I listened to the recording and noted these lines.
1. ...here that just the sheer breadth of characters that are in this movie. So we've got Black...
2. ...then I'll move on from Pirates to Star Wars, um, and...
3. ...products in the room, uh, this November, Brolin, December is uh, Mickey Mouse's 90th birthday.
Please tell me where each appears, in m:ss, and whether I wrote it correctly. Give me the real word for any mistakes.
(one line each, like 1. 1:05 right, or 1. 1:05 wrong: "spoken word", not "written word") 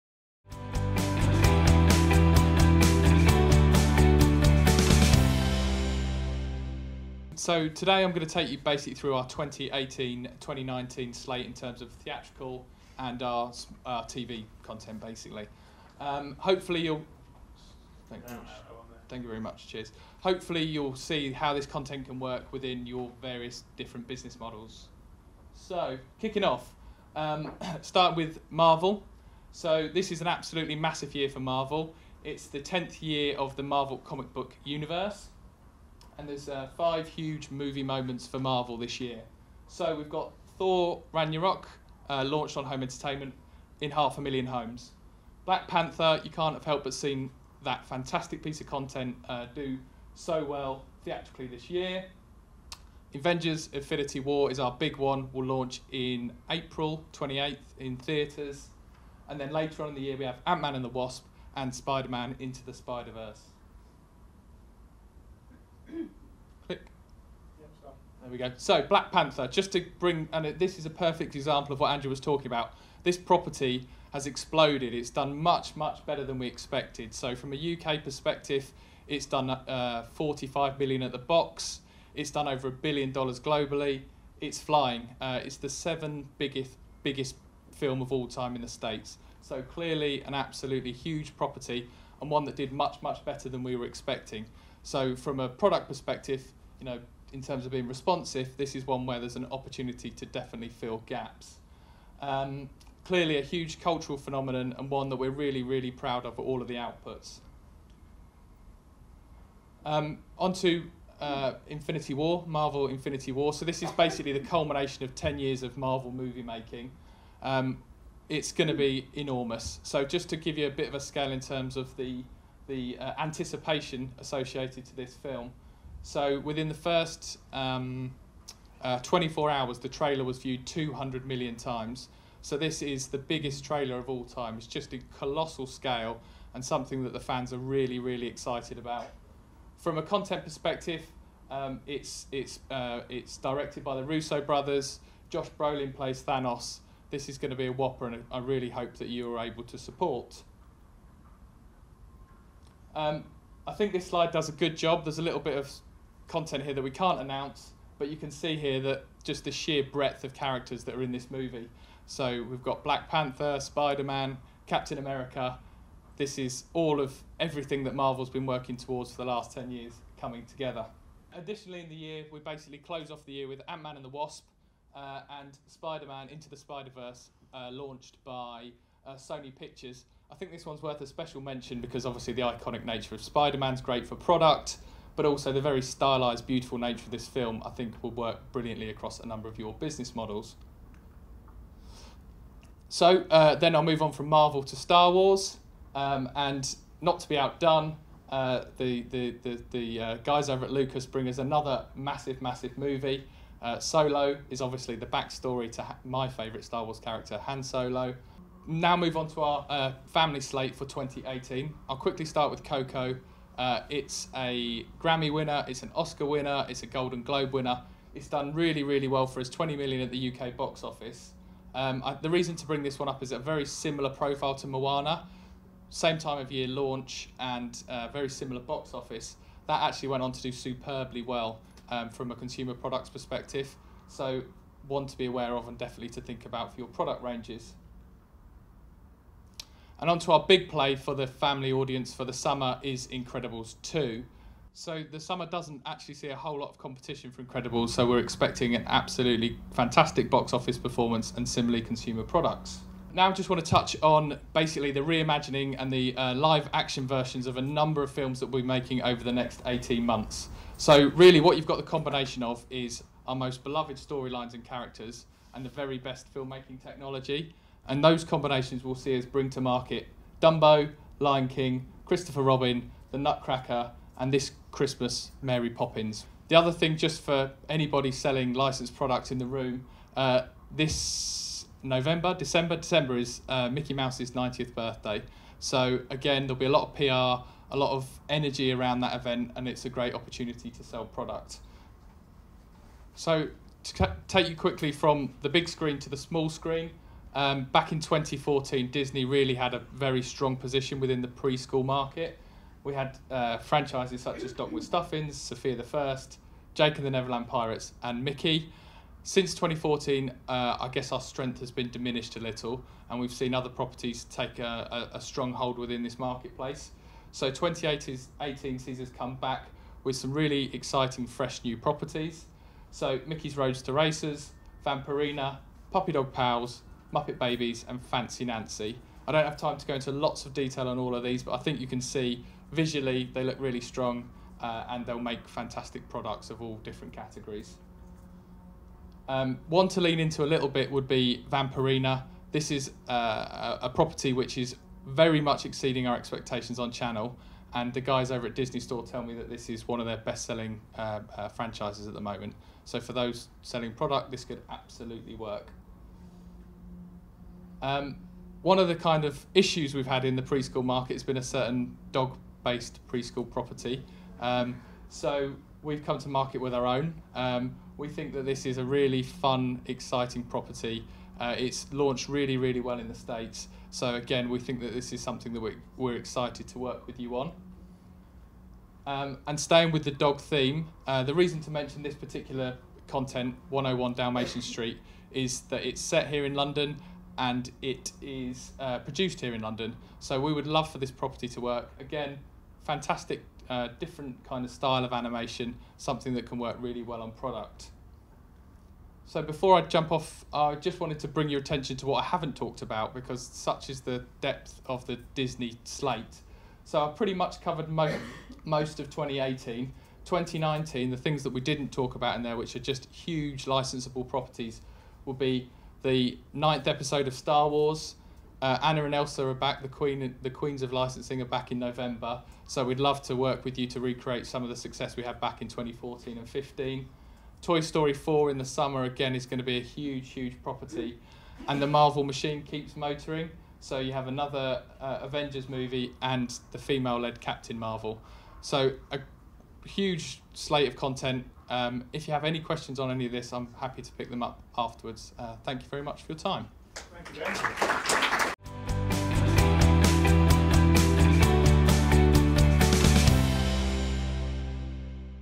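1. 2:38 right
2. 3:13 wrong: "Marvel", not "Pirates"
3. 4:38 wrong: "December", not "Brolin".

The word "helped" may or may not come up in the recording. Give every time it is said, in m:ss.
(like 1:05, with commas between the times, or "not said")
0:46.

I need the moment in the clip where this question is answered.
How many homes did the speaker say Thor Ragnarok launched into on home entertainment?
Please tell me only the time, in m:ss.
0:43.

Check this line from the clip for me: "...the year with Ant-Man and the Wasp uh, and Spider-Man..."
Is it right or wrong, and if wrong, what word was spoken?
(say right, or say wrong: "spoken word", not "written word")
right.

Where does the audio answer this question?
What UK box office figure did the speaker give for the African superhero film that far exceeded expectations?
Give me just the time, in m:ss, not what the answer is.
1:20.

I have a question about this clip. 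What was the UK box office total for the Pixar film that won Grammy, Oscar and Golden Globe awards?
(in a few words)
20 million.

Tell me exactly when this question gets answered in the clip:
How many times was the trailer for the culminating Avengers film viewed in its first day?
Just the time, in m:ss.
2:10.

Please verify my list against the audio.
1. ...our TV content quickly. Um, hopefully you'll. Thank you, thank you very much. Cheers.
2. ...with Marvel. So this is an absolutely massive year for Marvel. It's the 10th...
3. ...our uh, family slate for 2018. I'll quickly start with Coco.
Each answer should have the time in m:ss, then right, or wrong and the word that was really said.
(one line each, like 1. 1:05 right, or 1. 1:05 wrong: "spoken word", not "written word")
1. 0:13 wrong: "basically", not "quickly"
2. 0:28 right
3. 3:29 right.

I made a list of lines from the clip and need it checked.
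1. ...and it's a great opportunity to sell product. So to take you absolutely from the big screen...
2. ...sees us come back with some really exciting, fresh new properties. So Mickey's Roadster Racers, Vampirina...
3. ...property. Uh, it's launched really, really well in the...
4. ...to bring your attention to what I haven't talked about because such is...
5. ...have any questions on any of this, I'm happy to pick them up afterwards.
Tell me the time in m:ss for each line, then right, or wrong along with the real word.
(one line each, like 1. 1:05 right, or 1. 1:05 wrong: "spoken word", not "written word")
1. 4:49 wrong: "quickly", not "absolutely"
2. 5:18 right
3. 6:10 right
4. 6:41 right
5. 7:22 right.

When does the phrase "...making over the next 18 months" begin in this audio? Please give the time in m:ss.
4:18.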